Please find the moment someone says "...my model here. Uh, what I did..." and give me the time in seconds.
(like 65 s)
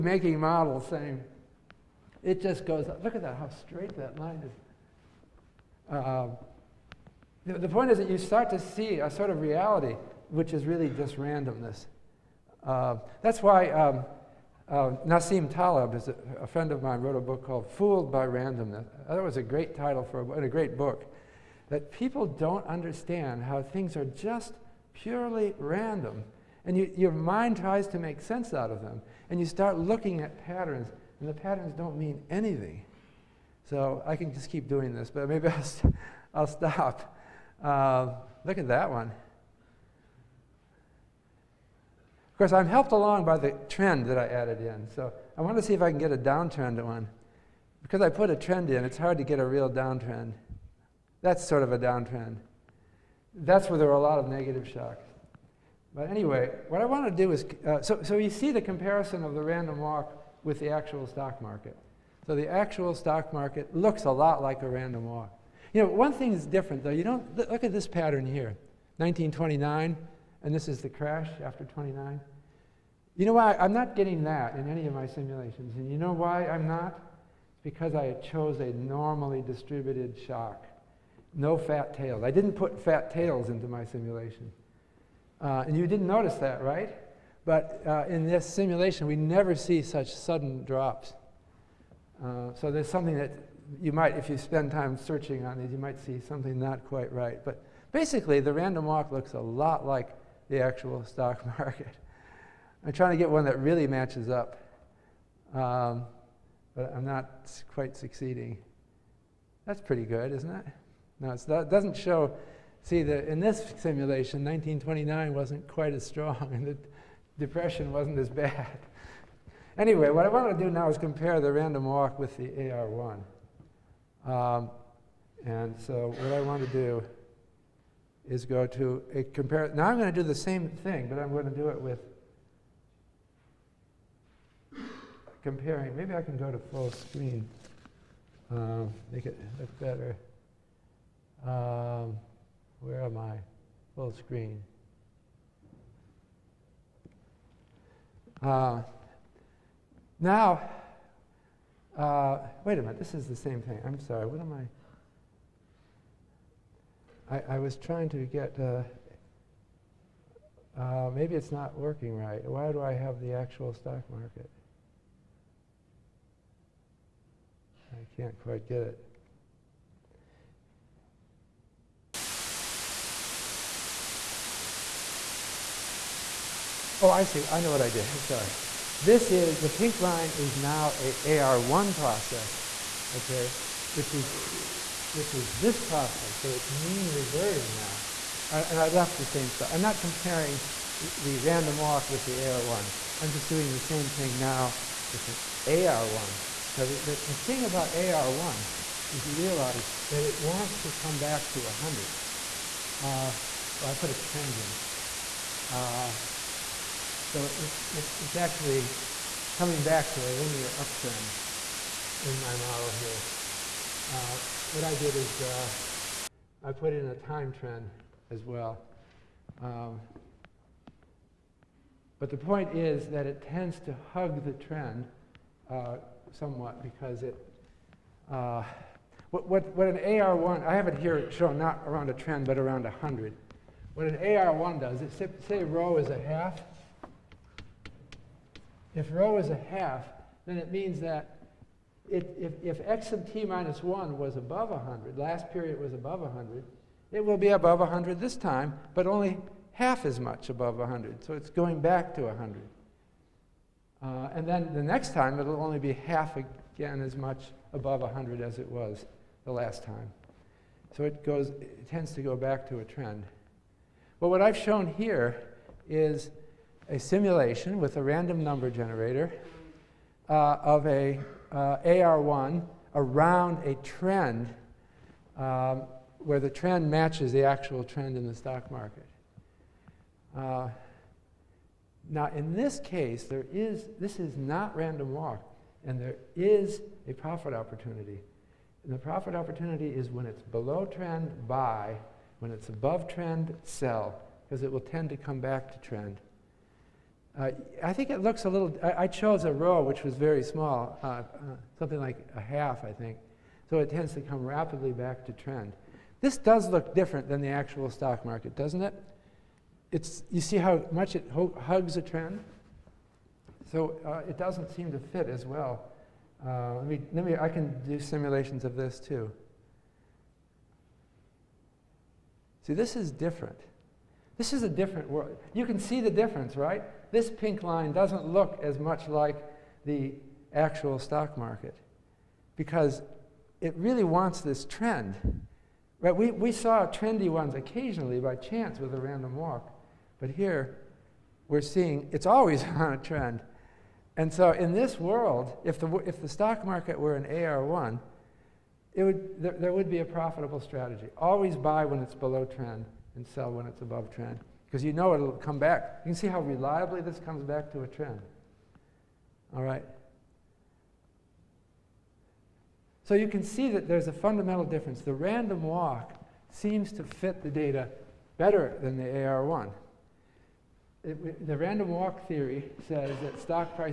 212 s.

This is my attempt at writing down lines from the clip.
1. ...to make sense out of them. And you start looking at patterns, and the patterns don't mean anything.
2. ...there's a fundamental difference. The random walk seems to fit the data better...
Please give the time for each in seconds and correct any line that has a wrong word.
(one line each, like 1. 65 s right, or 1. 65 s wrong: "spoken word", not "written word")
1. 27 s right
2. 363 s right.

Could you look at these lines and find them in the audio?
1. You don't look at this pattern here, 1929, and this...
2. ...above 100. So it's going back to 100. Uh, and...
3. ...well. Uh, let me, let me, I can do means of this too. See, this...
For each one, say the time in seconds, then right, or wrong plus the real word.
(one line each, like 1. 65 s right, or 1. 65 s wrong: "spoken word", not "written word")
1. 66 s right
2. 250 s right
3. 315 s wrong: "simulations", not "means".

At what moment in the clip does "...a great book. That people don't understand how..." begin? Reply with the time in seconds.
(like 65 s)
20 s.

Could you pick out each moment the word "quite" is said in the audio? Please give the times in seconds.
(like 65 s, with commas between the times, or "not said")
96 s, 107 s, 115 s, 168 s.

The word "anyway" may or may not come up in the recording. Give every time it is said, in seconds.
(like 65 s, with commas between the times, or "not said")
56 s, 119 s.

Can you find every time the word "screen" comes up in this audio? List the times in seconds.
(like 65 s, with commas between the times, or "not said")
136 s, 144 s.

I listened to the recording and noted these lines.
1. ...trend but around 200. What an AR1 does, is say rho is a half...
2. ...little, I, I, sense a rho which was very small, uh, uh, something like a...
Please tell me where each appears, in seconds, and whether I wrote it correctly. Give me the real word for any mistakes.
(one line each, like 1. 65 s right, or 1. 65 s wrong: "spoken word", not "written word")
1. 232 s wrong: "100", not "200"
2. 298 s wrong: "chose", not "sense".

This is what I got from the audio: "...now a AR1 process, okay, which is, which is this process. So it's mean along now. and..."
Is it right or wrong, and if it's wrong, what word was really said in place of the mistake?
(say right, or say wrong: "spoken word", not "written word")
wrong: "reverting", not "along".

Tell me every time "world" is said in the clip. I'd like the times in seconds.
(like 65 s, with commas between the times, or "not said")
325 s, 344 s.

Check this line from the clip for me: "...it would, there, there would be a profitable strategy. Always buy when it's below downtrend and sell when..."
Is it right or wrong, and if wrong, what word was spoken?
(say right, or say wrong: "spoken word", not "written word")
wrong: "trend", not "downtrend".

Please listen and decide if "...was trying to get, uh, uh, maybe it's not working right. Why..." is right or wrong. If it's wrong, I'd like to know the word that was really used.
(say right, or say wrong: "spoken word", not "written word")
right.